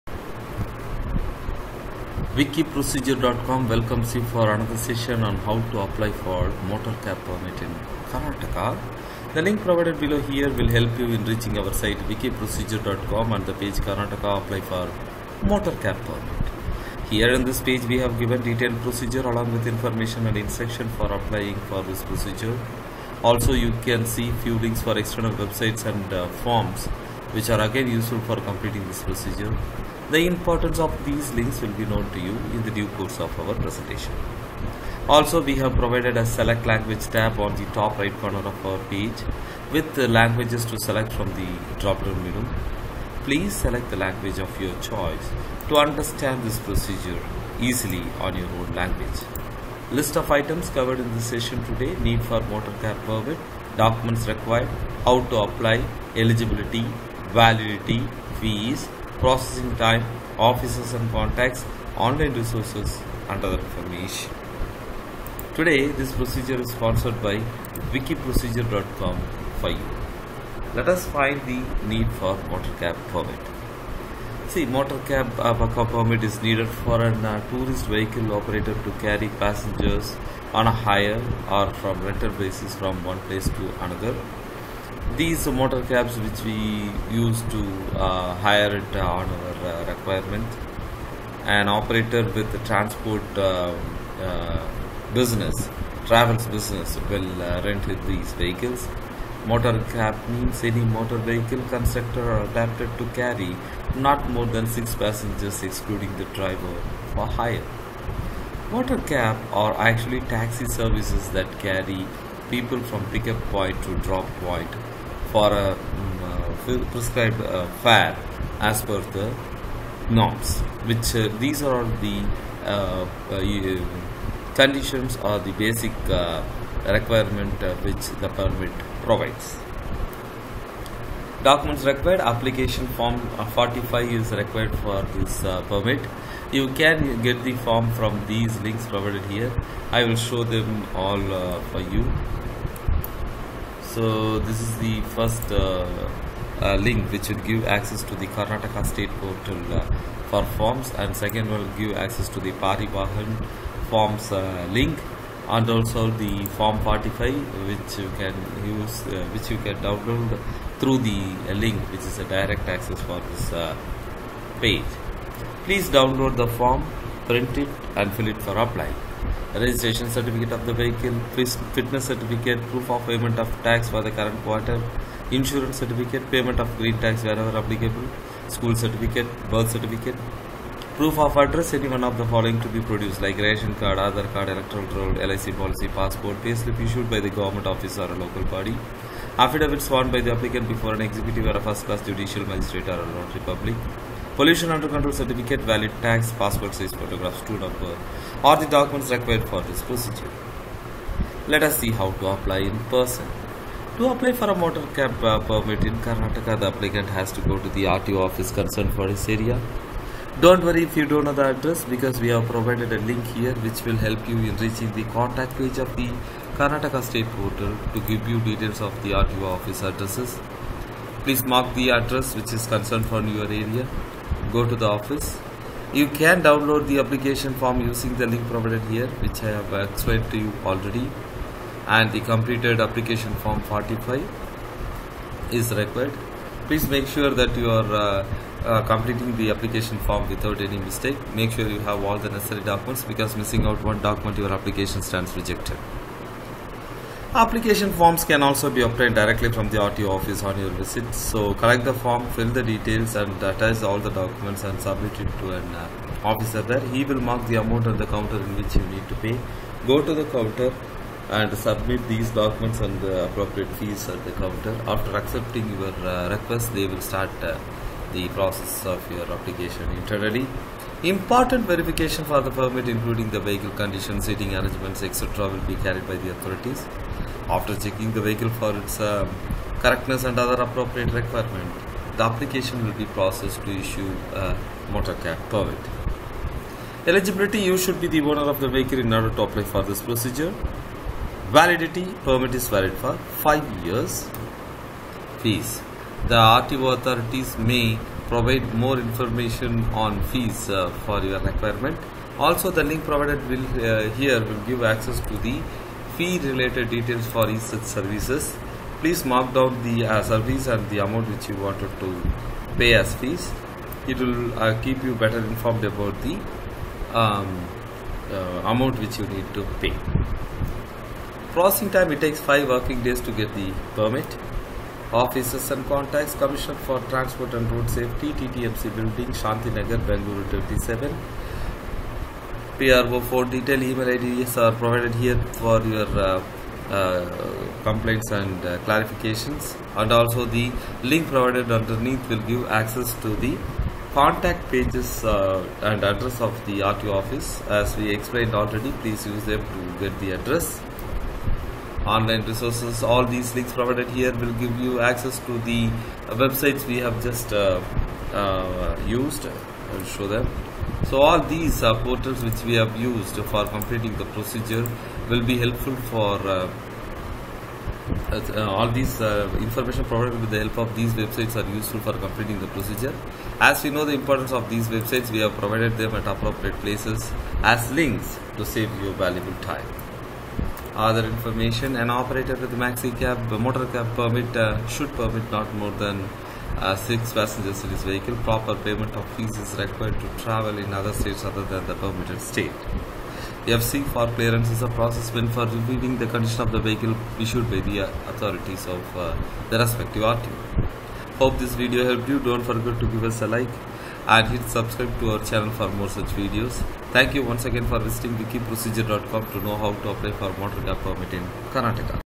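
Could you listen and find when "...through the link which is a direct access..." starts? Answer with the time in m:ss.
2:40.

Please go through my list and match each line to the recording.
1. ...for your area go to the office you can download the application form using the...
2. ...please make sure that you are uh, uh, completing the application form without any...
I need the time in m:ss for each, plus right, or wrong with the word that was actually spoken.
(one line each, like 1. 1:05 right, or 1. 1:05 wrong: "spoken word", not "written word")
1. 3:43 right
2. 3:56 right.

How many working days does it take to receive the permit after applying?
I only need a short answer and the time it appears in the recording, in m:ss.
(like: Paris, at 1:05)
5 working days, at 5:22.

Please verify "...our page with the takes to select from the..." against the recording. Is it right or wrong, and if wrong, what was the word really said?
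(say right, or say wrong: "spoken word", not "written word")
wrong: "languages", not "takes".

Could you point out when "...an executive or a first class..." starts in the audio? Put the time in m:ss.
3:10.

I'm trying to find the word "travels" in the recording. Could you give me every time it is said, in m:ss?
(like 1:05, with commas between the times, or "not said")
1:36, 6:30.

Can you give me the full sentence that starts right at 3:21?
Let us see how to apply in person.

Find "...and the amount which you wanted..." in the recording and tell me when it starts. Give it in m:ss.
5:10.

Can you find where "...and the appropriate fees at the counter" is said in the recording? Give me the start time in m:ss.
4:22.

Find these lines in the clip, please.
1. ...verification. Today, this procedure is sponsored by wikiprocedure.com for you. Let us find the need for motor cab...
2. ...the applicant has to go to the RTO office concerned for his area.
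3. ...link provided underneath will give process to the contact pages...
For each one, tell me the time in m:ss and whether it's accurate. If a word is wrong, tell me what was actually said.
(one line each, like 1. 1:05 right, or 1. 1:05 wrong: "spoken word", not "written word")
1. 1:03 wrong: "information", not "verification"
2. 3:26 right
3. 5:41 wrong: "access", not "process".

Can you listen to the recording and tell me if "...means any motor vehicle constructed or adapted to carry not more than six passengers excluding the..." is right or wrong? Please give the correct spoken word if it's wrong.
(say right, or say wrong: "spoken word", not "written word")
right.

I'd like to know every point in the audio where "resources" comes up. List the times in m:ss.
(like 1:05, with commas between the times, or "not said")
1:02, 5:52.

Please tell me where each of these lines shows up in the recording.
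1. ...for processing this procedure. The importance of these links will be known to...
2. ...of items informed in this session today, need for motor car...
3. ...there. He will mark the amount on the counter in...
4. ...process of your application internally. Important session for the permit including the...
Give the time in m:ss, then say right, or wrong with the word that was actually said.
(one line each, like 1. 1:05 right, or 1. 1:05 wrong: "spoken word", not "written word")
1. 0:28 wrong: "completing", not "processing"
2. 0:50 wrong: "covered", not "informed"
3. 4:16 right
4. 4:28 wrong: "verification", not "session".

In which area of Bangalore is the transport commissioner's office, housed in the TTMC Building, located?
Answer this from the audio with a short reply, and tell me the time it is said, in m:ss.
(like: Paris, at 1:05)
Shanti Nagar, at 5:29.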